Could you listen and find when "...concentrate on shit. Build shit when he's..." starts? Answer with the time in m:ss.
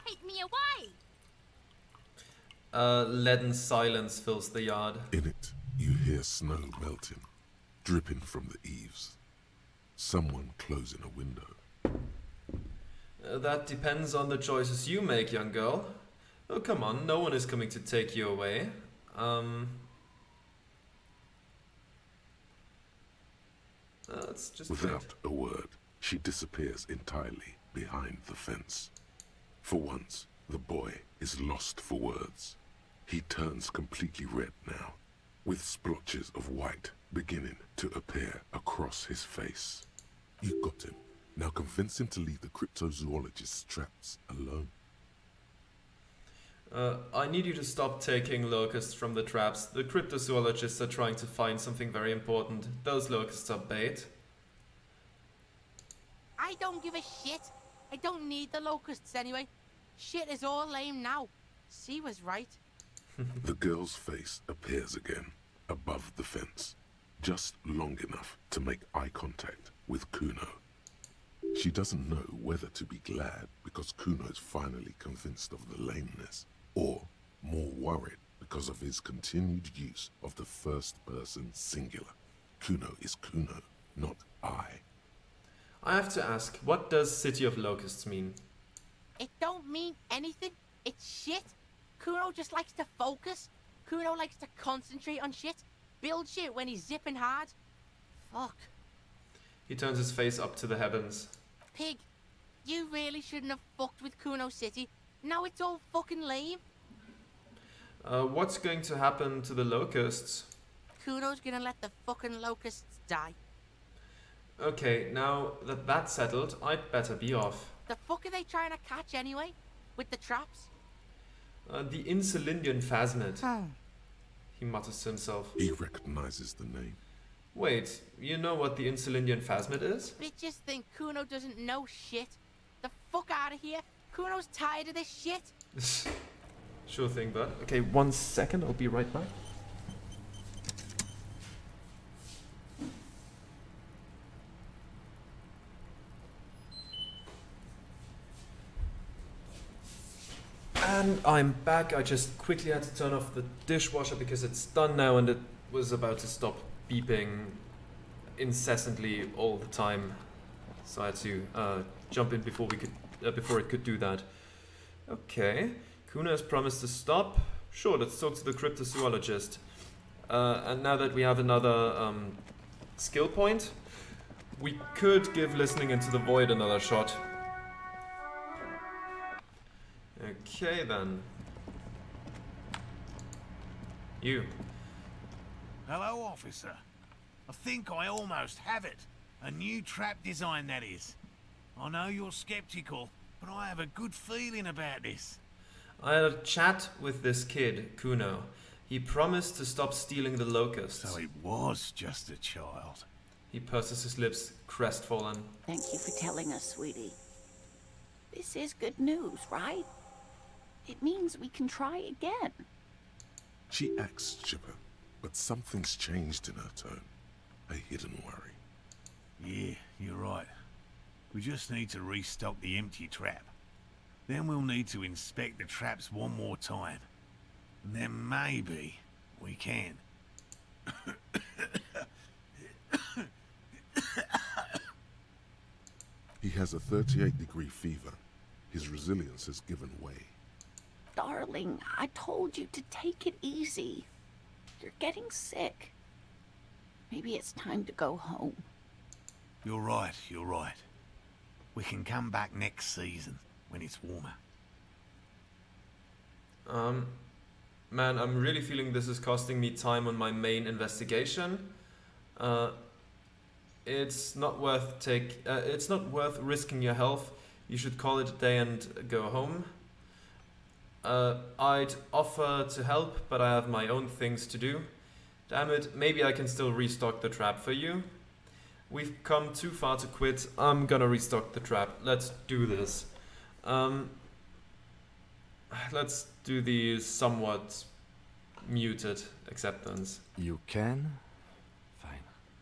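1:34.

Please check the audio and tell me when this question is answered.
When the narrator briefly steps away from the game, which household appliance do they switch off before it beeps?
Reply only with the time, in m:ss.
2:33.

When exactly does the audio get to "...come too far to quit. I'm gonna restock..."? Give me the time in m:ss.
4:39.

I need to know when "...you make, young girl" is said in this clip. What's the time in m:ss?
0:14.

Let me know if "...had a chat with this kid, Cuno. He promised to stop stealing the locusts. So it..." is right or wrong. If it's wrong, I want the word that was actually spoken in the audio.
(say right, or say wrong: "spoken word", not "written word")
right.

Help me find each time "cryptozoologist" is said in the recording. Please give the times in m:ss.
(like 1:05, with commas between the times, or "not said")
0:42, 0:49, 2:48.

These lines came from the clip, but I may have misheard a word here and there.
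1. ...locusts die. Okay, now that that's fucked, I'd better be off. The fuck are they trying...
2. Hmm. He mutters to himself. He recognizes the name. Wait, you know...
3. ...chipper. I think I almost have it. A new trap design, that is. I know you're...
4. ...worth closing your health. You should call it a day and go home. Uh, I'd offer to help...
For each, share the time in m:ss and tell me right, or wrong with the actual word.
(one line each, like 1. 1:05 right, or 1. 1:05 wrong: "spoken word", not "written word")
1. 1:52 wrong: "settled", not "fucked"
2. 2:03 right
3. 3:06 wrong: "officer", not "chipper"
4. 4:26 wrong: "risking", not "closing".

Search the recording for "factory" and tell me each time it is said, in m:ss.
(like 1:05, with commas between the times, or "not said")
not said.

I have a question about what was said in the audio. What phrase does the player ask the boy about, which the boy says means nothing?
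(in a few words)
City of Locusts.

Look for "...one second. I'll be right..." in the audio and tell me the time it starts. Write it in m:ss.
2:17.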